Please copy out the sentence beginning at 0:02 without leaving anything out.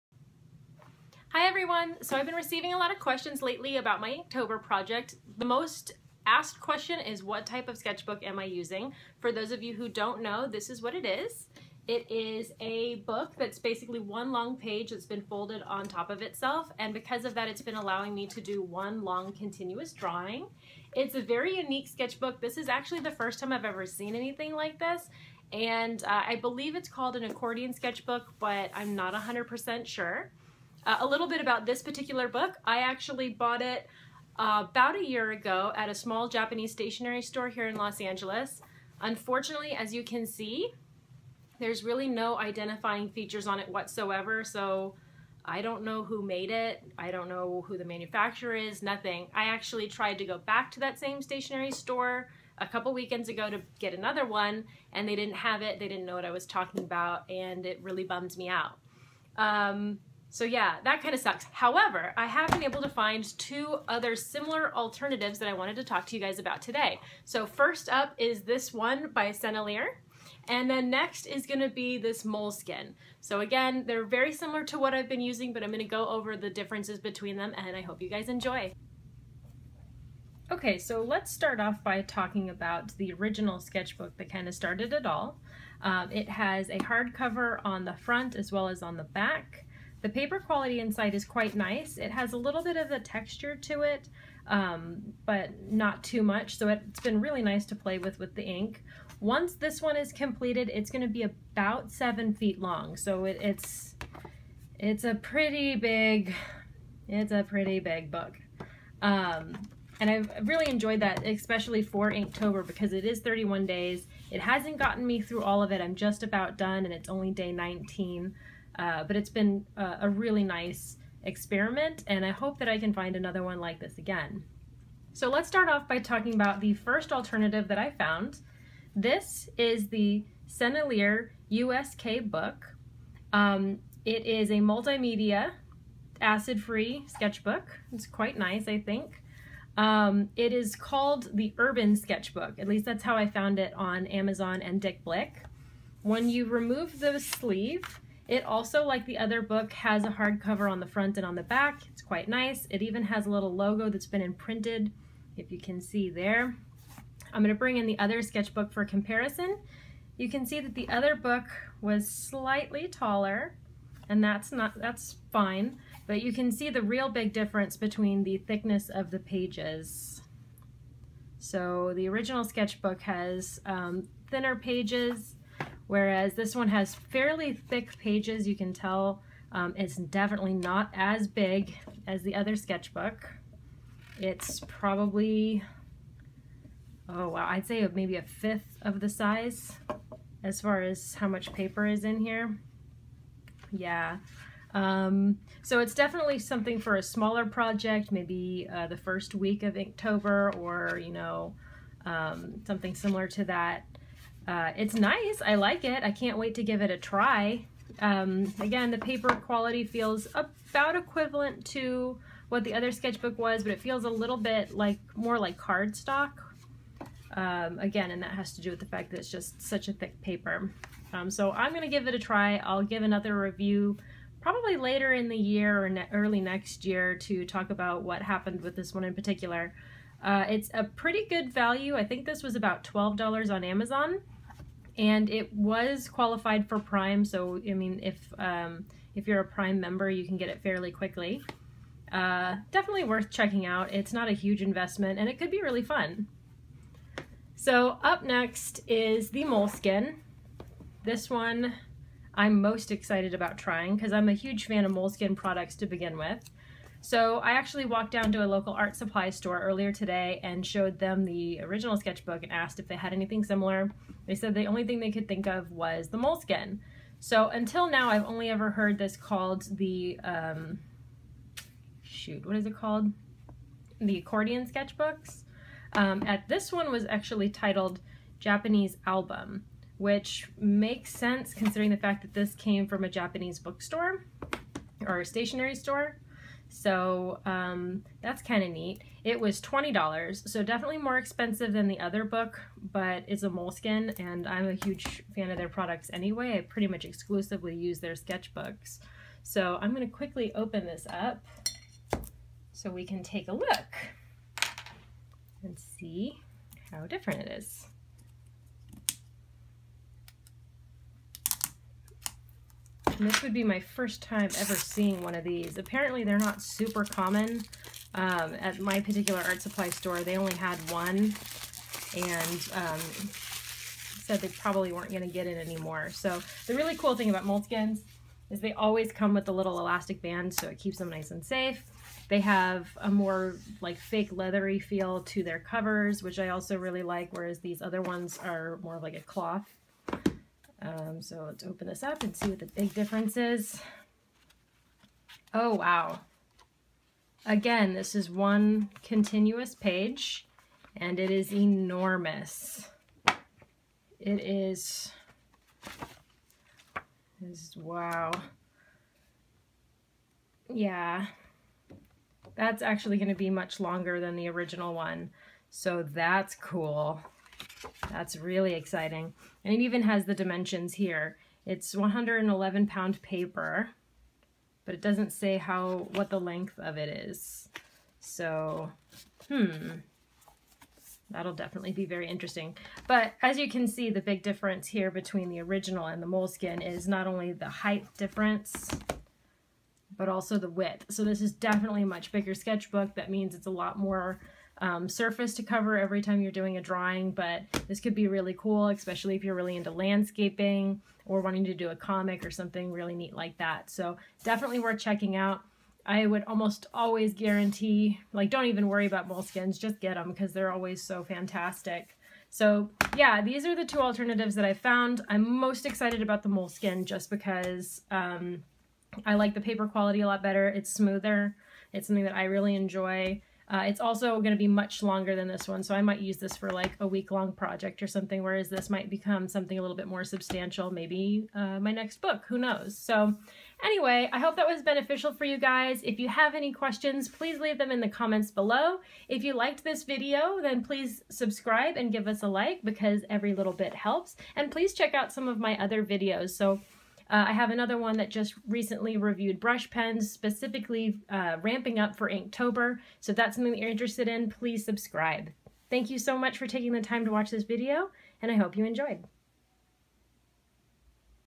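So I've been receiving a lot of questions lately about my Inktober project.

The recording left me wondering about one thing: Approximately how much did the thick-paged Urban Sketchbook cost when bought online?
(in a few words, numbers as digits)
$12.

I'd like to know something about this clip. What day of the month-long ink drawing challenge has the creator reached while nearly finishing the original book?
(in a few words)
Day 19.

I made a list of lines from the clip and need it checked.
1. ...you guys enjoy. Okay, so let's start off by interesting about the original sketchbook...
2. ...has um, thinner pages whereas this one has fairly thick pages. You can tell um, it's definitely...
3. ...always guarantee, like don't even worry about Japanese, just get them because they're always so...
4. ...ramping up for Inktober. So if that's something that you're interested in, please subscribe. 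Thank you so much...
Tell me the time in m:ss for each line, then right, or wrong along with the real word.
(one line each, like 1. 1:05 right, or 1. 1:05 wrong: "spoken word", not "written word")
1. 1:18 wrong: "talking", not "interesting"
2. 2:53 right
3. 6:46 wrong: "Moleskines", not "Japanese"
4. 7:31 right.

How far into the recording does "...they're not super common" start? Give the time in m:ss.
5:16.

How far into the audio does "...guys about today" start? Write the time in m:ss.
1:06.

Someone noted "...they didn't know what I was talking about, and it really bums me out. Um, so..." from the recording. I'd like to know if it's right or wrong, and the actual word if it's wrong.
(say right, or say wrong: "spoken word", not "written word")
right.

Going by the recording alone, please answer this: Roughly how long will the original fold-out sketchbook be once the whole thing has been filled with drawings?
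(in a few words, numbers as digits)
7 feet.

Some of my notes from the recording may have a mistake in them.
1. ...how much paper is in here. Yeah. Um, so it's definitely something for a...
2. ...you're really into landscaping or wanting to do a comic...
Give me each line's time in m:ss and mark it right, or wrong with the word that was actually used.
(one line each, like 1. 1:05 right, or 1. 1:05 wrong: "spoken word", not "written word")
1. 3:11 right
2. 6:39 right.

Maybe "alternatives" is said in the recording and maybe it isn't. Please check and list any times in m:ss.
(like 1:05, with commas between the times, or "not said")
1:04, 2:07, 6:53.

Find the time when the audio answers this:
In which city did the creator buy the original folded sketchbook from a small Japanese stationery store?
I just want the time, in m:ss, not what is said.
0:37.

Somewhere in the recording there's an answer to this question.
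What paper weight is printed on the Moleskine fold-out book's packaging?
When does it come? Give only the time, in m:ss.
6:11.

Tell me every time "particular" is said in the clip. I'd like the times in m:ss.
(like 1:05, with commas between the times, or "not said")
0:31, 3:49, 5:18.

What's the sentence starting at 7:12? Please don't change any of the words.
So anyway, I hope that was beneficial for you guys.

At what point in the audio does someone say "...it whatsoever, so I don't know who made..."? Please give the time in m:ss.
0:43.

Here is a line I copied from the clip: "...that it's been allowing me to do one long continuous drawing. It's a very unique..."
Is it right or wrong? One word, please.
right.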